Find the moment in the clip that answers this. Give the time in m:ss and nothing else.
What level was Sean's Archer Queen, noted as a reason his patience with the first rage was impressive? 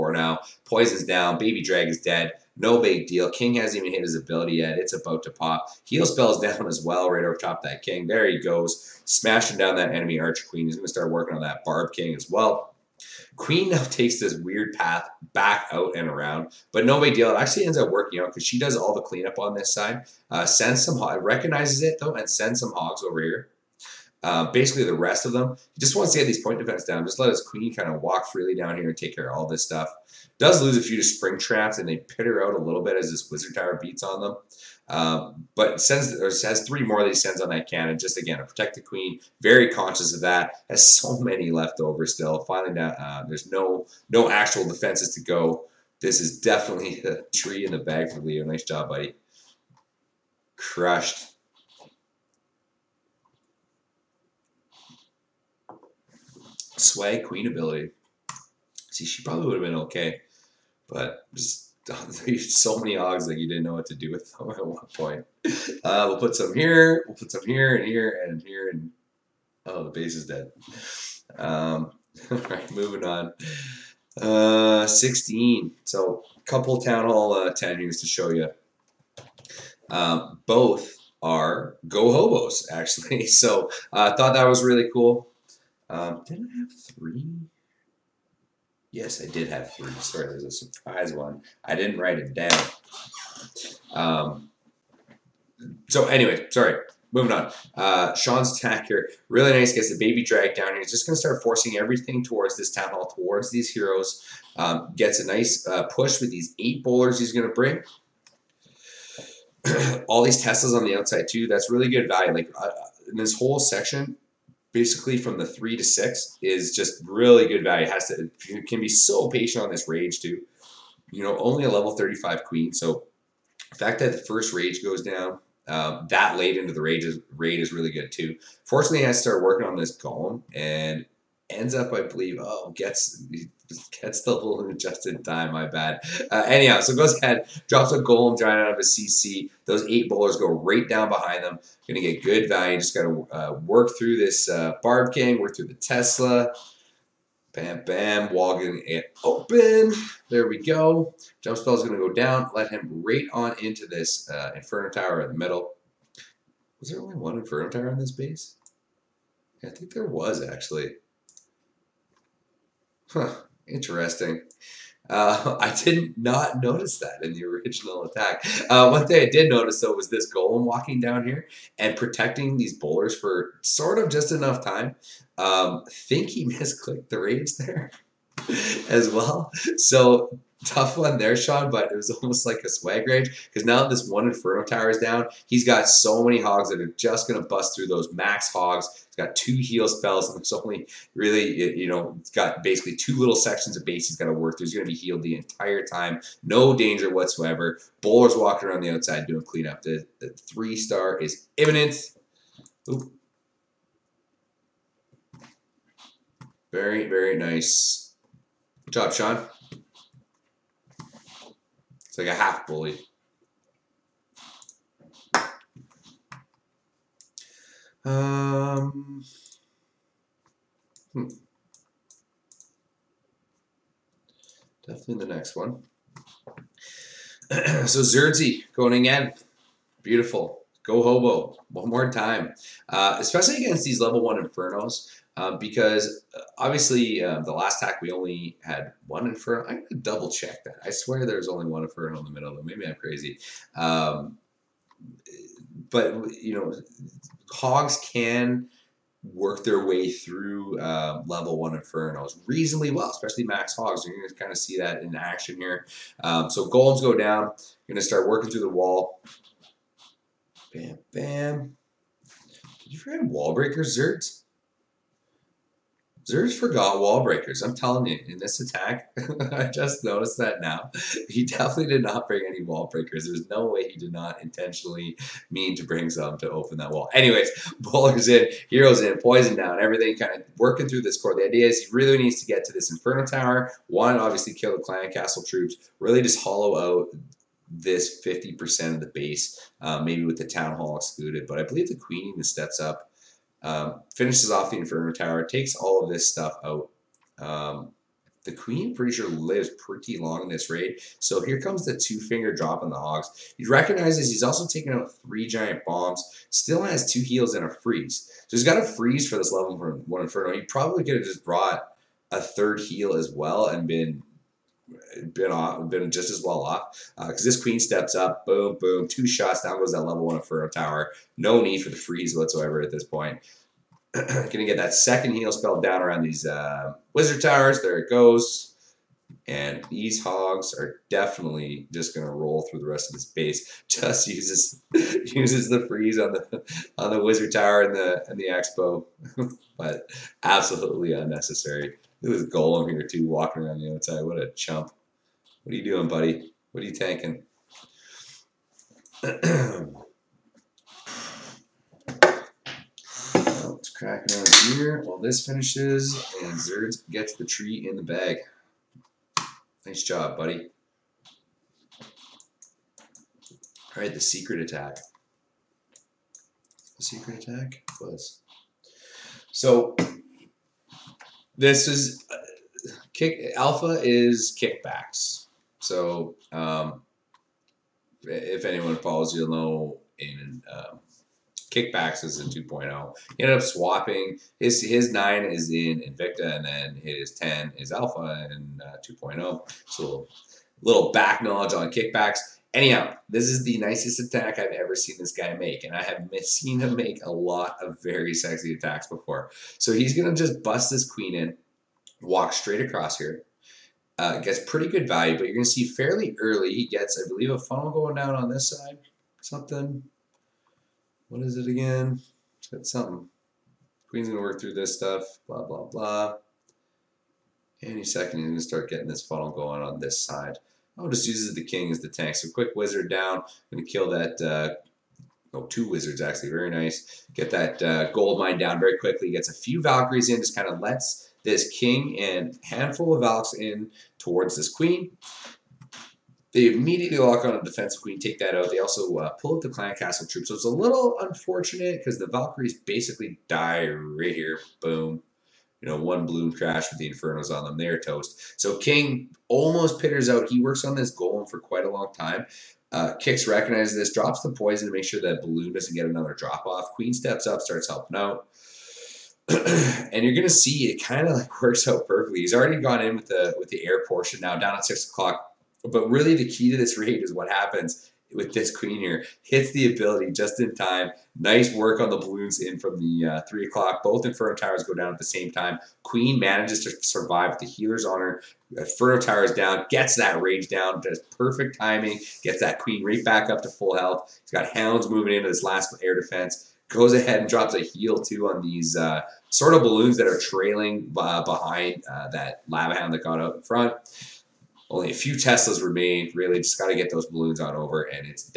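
2:01.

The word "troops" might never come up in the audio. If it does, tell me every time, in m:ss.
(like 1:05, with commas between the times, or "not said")
4:45, 7:20.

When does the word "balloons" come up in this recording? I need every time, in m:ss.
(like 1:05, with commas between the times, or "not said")
7:35, 7:52, 8:09, 8:17.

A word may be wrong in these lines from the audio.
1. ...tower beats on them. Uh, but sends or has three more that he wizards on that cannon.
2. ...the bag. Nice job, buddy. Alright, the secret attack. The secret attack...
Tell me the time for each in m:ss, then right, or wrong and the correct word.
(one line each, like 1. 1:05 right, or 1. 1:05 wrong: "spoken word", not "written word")
1. 0:33 wrong: "sends", not "wizards"
2. 5:57 right.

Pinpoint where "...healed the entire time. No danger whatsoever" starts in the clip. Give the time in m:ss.
3:14.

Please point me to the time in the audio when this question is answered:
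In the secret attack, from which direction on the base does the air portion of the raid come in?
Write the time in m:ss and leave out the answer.
7:44.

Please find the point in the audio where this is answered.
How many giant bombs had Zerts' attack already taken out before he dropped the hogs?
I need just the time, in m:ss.
5:05.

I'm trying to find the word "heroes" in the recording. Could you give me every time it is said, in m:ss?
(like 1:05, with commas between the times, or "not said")
1:43, 4:38.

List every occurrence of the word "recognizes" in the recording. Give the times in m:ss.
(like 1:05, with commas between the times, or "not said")
0:21, 5:03, 7:33.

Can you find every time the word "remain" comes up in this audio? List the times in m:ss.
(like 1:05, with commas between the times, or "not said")
8:15.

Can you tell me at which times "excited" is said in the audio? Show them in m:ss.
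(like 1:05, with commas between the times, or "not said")
not said.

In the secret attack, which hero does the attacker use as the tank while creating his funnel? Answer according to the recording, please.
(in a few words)
The king.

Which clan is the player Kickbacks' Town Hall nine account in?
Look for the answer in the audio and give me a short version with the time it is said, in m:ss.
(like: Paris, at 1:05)
Invicta, at 6:25.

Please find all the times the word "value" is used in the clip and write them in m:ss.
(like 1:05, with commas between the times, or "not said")
1:52, 1:57, 2:22, 6:45.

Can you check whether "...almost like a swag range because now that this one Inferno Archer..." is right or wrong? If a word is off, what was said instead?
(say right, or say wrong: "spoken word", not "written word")
wrong: "Tower", not "Archer".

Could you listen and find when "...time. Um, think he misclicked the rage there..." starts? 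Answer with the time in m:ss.
2:54.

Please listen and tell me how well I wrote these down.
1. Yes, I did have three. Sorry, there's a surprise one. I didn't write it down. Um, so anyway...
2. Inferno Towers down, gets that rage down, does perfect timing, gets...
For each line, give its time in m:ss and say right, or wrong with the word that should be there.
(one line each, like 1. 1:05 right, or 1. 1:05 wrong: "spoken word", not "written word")
1. 1:28 right
2. 7:58 right.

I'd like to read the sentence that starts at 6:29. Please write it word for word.
So little back knowledge on kickbacks.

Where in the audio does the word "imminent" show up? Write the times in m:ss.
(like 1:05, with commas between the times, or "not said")
3:21.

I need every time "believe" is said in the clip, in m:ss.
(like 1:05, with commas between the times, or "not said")
2:12, 4:51, 6:47.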